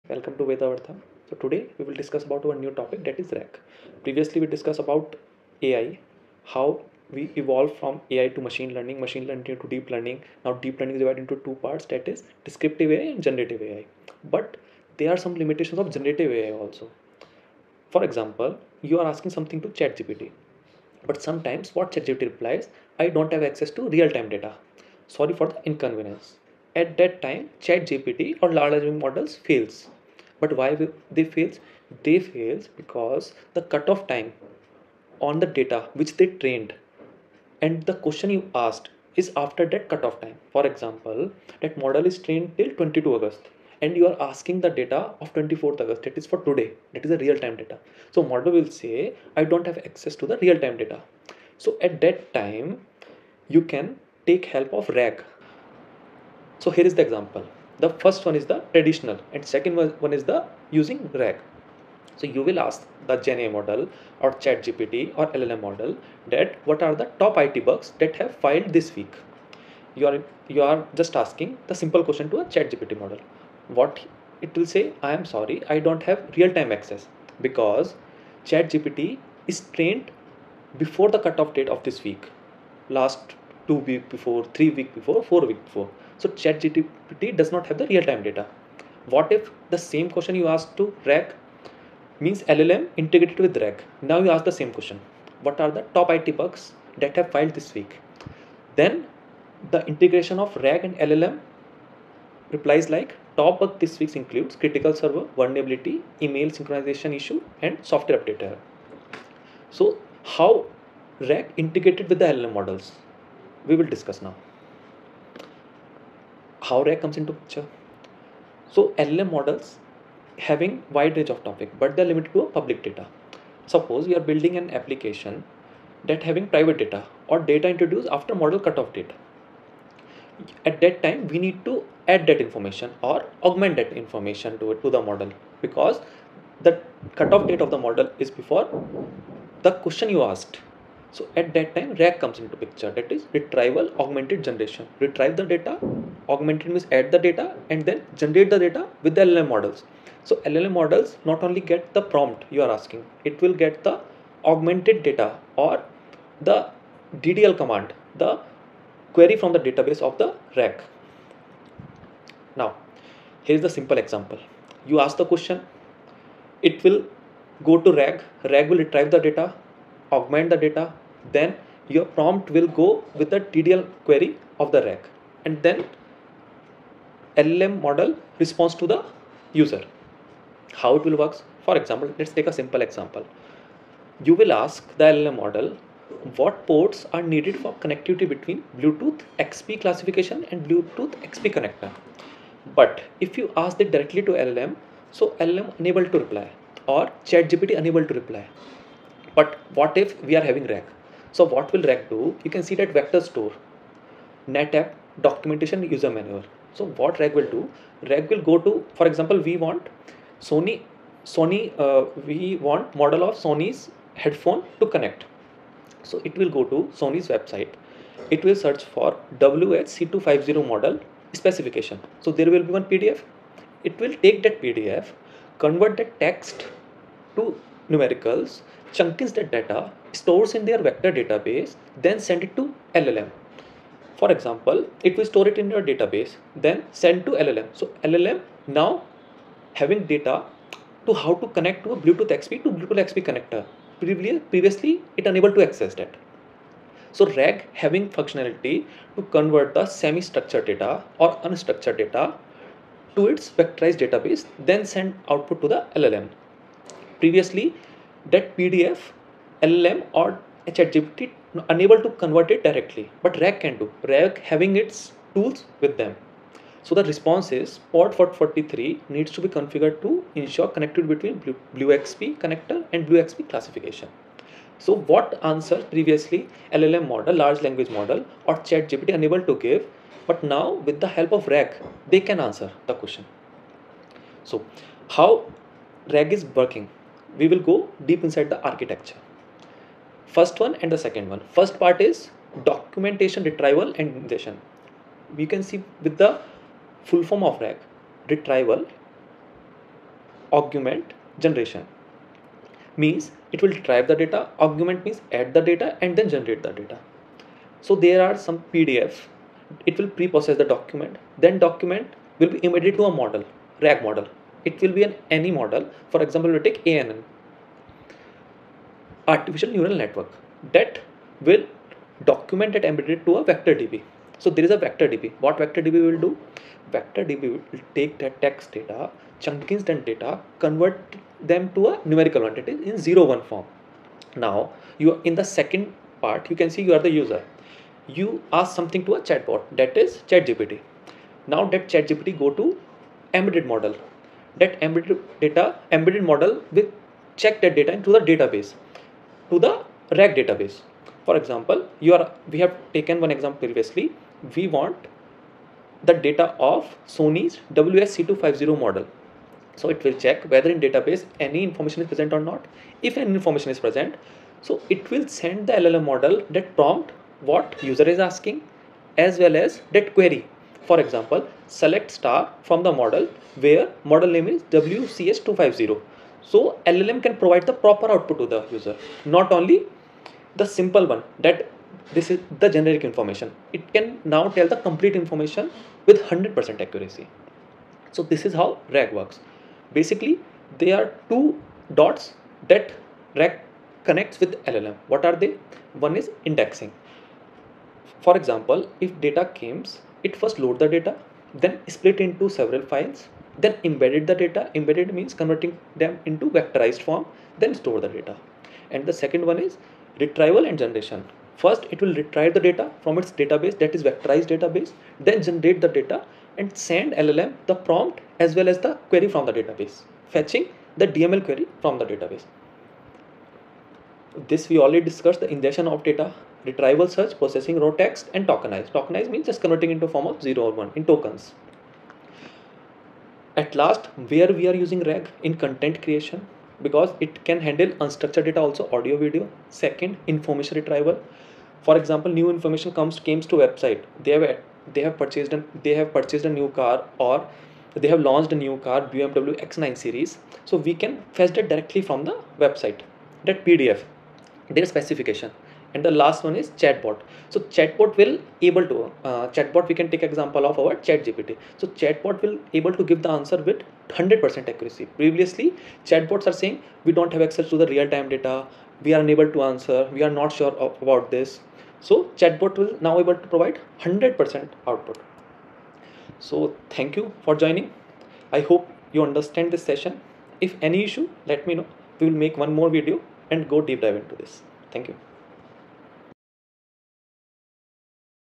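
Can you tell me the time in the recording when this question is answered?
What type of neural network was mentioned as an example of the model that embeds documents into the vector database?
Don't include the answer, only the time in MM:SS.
05:19.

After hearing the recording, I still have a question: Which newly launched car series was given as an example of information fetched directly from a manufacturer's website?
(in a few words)
BMW X9 series.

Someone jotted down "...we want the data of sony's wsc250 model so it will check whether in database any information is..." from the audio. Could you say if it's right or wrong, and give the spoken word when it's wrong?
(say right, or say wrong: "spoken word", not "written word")
right.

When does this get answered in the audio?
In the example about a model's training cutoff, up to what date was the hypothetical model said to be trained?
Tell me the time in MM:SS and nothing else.
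00:42.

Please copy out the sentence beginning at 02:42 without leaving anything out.
Now, here is the simple example.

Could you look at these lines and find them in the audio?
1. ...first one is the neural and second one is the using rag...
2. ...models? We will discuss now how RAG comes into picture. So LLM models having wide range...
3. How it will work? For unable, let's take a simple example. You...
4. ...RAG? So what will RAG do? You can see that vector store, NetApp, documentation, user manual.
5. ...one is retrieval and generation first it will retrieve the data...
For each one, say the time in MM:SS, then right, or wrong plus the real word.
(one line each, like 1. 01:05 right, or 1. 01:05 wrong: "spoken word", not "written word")
1. 00:58 wrong: "traditional", not "neural"
2. 01:52 right
3. 03:00 wrong: "example", not "unable"
4. 03:20 right
5. 06:49 right.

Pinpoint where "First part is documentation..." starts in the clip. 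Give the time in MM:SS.
04:51.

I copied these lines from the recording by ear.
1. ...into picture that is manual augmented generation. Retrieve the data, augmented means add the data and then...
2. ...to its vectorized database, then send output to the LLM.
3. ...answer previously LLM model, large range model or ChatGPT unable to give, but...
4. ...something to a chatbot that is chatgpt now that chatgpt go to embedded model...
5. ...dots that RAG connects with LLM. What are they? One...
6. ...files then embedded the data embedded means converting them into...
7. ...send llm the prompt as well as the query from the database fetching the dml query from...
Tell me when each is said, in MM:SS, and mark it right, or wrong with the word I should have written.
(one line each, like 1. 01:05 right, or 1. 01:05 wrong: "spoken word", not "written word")
1. 02:22 wrong: "retrieval", not "manual"
2. 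04:13 right
3. 04:35 wrong: "language", not "range"
4. 05:38 right
5. 06:31 right
6. 06:42 right
7. 06:56 right.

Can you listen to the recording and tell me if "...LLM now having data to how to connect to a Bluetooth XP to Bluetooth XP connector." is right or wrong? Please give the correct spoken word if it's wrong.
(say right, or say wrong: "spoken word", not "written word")
right.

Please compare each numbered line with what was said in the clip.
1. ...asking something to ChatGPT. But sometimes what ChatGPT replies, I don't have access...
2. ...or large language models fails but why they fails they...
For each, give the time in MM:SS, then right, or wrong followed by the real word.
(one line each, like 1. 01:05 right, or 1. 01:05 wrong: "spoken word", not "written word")
1. 00:19 right
2. 00:28 right.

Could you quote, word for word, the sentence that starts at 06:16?
So LLM can provide the proper output to the user, not only the simple one that this is the generic information.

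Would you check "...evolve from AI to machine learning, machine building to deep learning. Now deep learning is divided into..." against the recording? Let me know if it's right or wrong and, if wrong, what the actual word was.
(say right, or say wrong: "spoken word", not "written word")
wrong: "learning", not "building".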